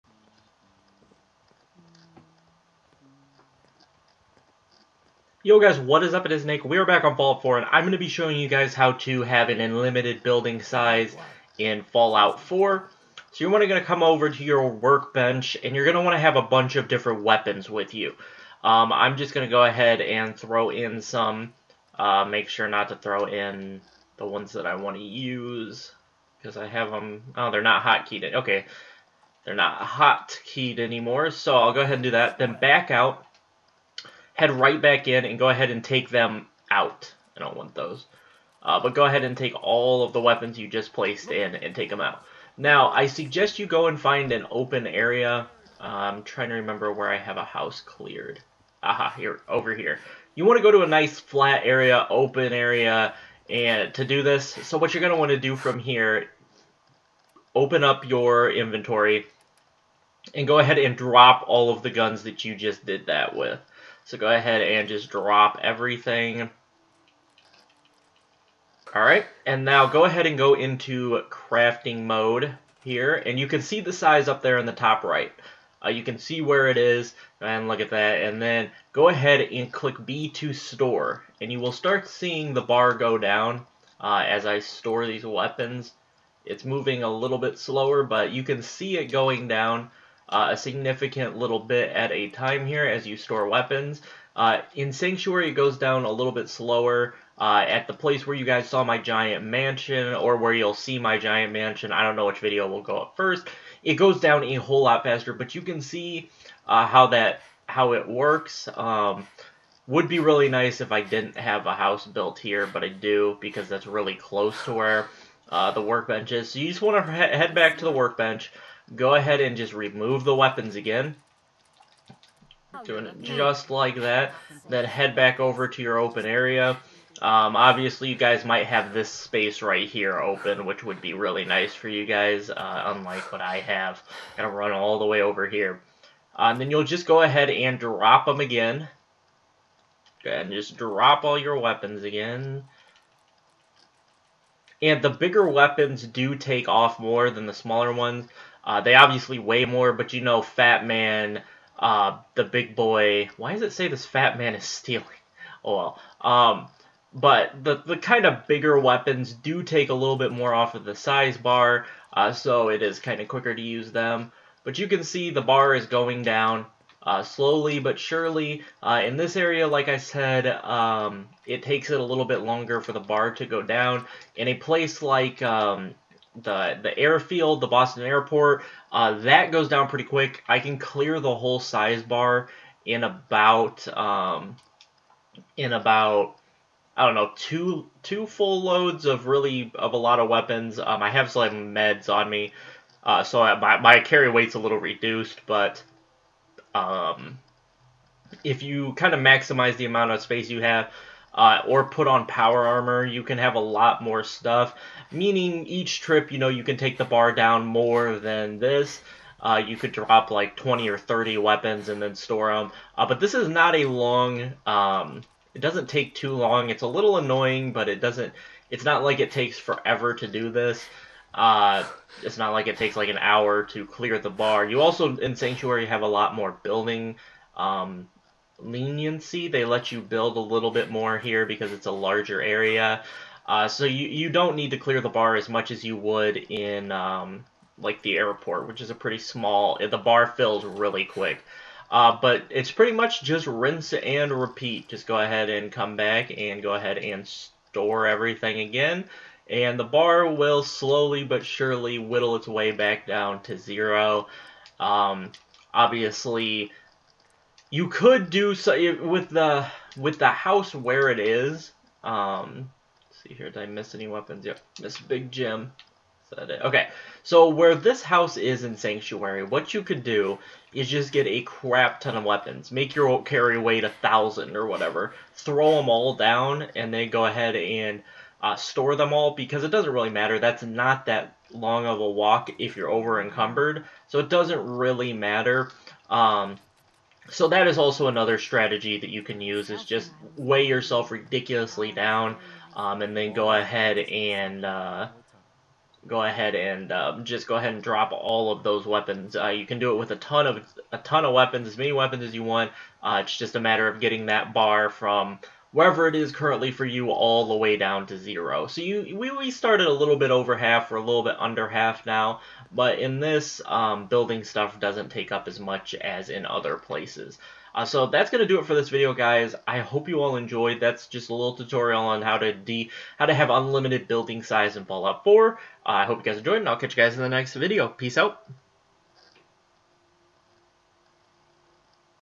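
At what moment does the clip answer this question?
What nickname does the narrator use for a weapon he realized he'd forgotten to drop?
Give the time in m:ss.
4:24.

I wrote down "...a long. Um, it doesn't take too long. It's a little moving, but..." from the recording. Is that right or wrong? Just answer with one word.
wrong.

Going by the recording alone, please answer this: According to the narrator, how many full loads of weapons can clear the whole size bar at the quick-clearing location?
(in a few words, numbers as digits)
2.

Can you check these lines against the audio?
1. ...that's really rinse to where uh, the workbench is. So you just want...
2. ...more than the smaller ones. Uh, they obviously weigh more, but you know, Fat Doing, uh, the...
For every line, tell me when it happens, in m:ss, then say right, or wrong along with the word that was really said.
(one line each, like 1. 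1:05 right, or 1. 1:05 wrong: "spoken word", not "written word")
1. 1:53 wrong: "close", not "rinse"
2. 2:26 wrong: "Man", not "Doing".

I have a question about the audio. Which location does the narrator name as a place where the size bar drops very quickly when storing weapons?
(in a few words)
Boston airport.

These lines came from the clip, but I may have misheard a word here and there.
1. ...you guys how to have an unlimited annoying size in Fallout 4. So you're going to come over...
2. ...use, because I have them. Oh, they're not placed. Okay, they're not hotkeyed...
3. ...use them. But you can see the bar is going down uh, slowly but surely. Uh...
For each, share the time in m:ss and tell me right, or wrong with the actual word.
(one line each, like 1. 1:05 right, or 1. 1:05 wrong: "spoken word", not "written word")
1. 0:08 wrong: "building", not "annoying"
2. 0:25 wrong: "hotkeyed", not "placed"
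3. 2:43 right.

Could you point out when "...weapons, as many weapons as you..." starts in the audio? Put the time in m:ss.
5:01.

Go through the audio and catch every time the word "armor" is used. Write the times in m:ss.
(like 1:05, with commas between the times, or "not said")
3:22.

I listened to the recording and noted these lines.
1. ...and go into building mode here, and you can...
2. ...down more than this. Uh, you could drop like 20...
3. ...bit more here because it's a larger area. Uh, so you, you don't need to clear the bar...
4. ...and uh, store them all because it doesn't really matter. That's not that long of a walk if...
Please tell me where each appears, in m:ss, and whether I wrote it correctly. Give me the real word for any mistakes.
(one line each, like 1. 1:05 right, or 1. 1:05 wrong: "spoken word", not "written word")
1. 1:10 wrong: "crafting", not "building"
2. 3:27 right
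3. 3:50 right
4. 4:37 right.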